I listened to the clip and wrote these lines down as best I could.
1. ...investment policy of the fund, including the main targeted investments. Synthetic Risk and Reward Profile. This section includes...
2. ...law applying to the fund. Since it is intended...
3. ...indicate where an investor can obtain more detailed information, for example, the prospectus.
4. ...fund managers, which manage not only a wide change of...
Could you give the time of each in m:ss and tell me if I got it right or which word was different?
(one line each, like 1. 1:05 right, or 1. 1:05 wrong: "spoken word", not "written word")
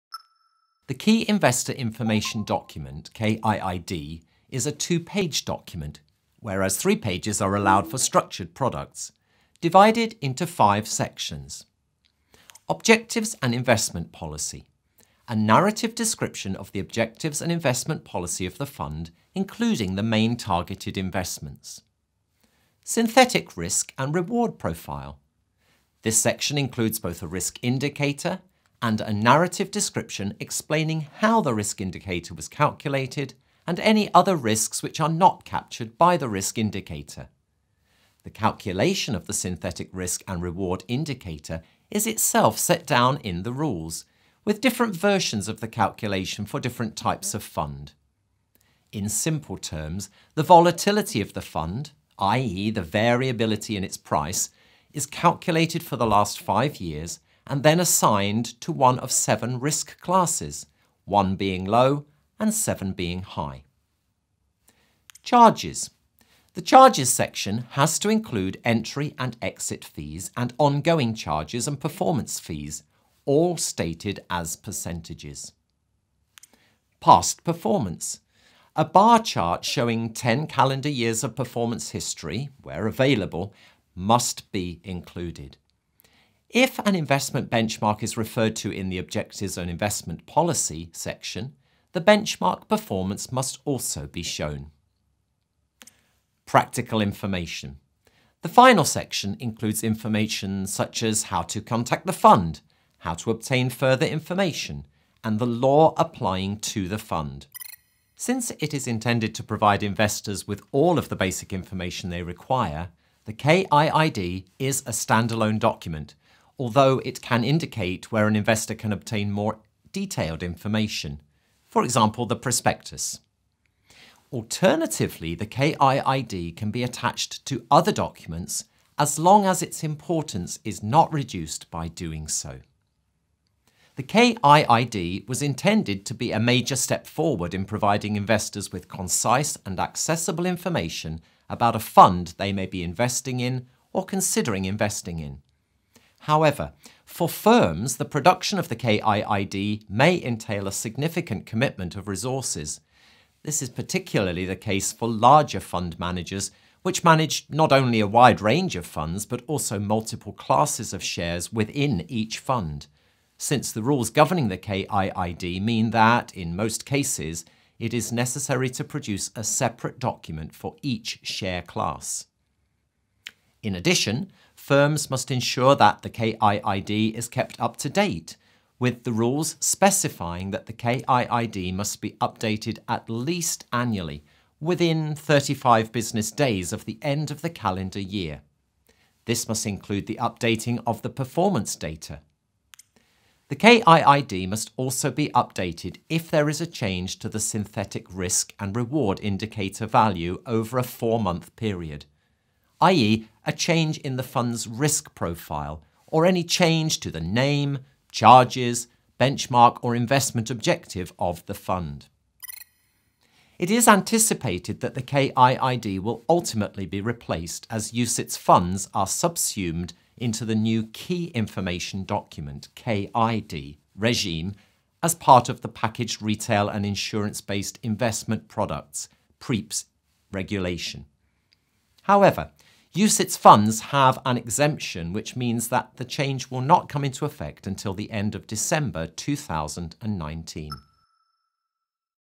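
1. 0:17 right
2. 1:45 right
3. 1:57 right
4. 2:35 wrong: "range", not "change".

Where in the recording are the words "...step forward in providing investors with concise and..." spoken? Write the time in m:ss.
2:16.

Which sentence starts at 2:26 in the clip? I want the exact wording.
However, for firms, the production of the KIID may entail a significant commitment of resources.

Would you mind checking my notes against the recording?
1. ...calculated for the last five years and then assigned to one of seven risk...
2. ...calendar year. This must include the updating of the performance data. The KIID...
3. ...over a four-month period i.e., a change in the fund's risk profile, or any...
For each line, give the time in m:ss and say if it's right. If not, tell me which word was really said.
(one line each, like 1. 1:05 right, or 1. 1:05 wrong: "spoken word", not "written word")
1. 0:55 right
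2. 3:07 right
3. 3:20 right.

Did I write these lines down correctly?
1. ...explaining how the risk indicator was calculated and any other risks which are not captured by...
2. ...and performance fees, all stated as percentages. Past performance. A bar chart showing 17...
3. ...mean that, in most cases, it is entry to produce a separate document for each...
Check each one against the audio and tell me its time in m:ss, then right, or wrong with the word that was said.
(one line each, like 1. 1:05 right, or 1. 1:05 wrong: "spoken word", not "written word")
1. 0:30 right
2. 1:11 wrong: "10", not "17"
3. 2:45 wrong: "necessary", not "entry".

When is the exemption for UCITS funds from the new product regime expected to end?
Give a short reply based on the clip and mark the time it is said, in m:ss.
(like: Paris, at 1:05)
end of December 2019, at 3:58.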